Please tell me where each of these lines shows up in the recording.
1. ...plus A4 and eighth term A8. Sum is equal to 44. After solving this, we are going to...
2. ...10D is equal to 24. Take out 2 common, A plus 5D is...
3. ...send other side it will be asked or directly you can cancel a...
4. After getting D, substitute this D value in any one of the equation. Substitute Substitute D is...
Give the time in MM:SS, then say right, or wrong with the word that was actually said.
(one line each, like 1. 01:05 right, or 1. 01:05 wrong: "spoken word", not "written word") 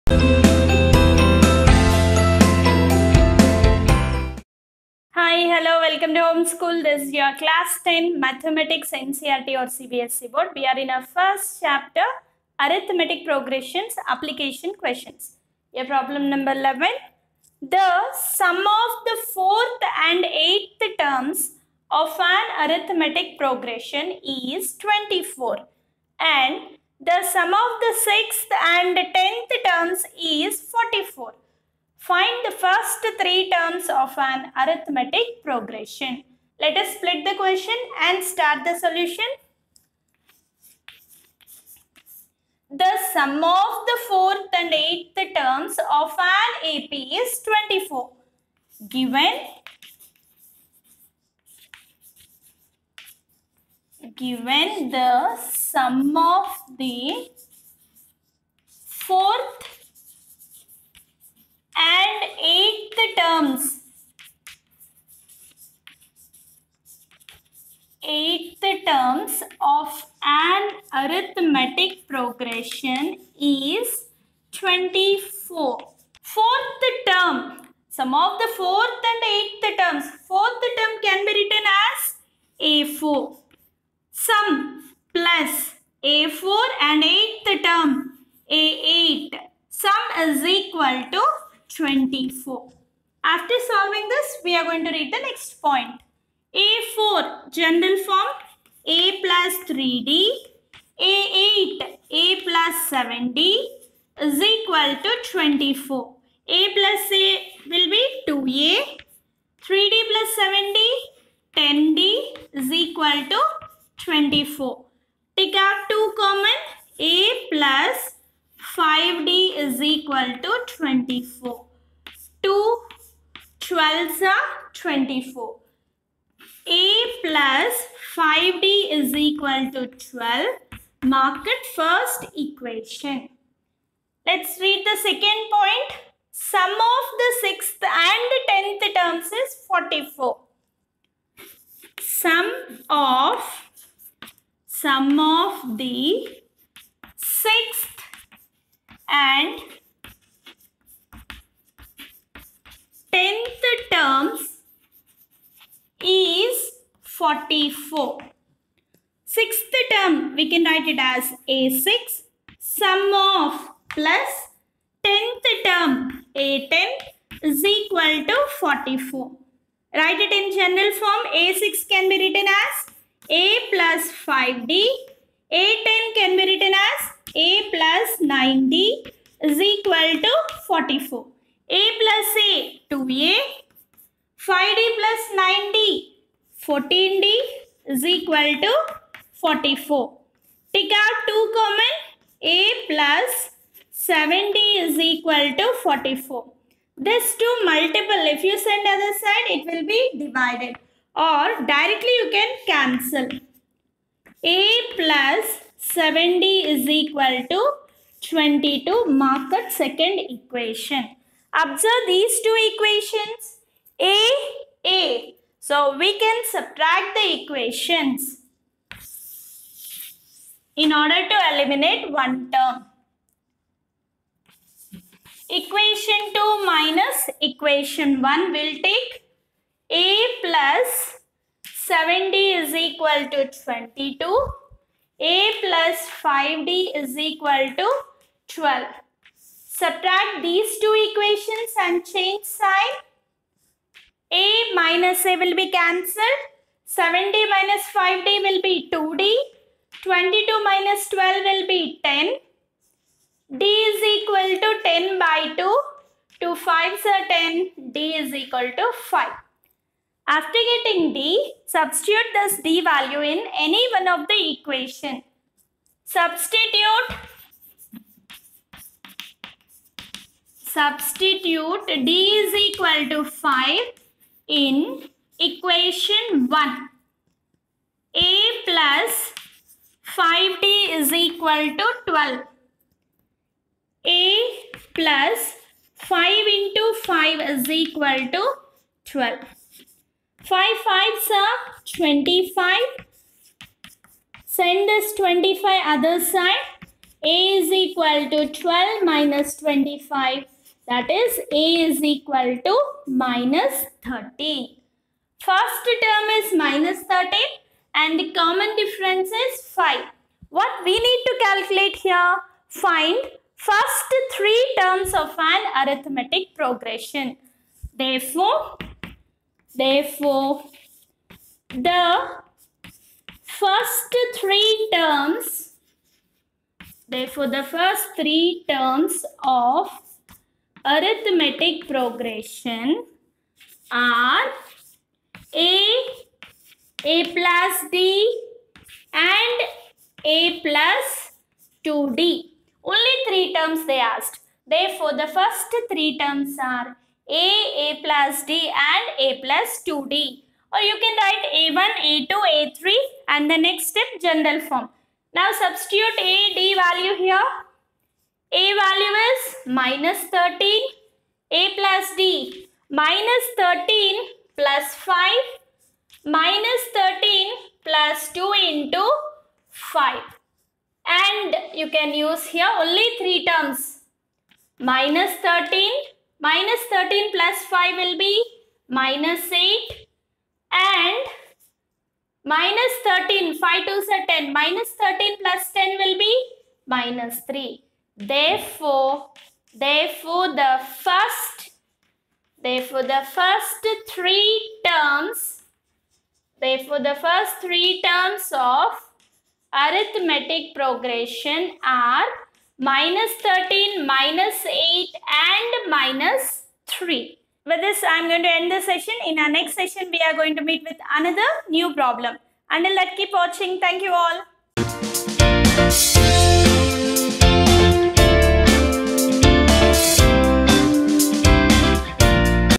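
1. 01:25 wrong: "24", not "44"
2. 01:51 right
3. 03:18 wrong: "divided", not "asked"
4. 04:20 right.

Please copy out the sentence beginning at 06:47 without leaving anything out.
With this, I am going to end the session.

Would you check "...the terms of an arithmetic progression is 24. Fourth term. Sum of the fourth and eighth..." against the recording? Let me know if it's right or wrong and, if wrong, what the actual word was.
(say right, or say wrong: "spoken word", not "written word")
right.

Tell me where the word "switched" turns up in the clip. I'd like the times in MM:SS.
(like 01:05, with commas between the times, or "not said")
not said.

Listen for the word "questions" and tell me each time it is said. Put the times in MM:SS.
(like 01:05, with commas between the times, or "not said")
00:14, 00:37.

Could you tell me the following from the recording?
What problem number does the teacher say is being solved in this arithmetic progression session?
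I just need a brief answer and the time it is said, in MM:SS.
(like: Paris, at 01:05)
11, at 00:15.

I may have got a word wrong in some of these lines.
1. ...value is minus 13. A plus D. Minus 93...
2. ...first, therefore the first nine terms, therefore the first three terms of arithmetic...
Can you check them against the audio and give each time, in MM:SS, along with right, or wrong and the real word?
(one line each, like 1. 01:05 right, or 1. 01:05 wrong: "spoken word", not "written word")
1. 05:58 wrong: "13", not "93"
2. 06:31 wrong: "three", not "nine".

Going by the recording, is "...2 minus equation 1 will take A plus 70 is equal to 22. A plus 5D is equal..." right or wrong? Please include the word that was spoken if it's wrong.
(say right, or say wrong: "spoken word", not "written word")
right.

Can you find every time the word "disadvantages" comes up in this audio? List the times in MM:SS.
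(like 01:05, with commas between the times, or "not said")
not said.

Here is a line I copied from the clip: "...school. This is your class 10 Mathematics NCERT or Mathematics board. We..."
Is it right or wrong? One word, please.
wrong.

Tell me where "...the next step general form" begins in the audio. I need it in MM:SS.
05:53.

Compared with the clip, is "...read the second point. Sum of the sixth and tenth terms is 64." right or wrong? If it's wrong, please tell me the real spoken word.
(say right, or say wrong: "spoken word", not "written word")
wrong: "44", not "64".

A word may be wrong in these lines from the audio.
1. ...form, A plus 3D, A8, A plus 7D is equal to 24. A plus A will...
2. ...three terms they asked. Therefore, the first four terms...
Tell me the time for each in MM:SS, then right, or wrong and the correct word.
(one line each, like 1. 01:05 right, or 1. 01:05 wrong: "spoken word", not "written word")
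1. 01:38 right
2. 05:43 wrong: "three", not "four".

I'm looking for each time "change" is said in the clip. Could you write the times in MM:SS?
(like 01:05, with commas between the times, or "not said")
04:02.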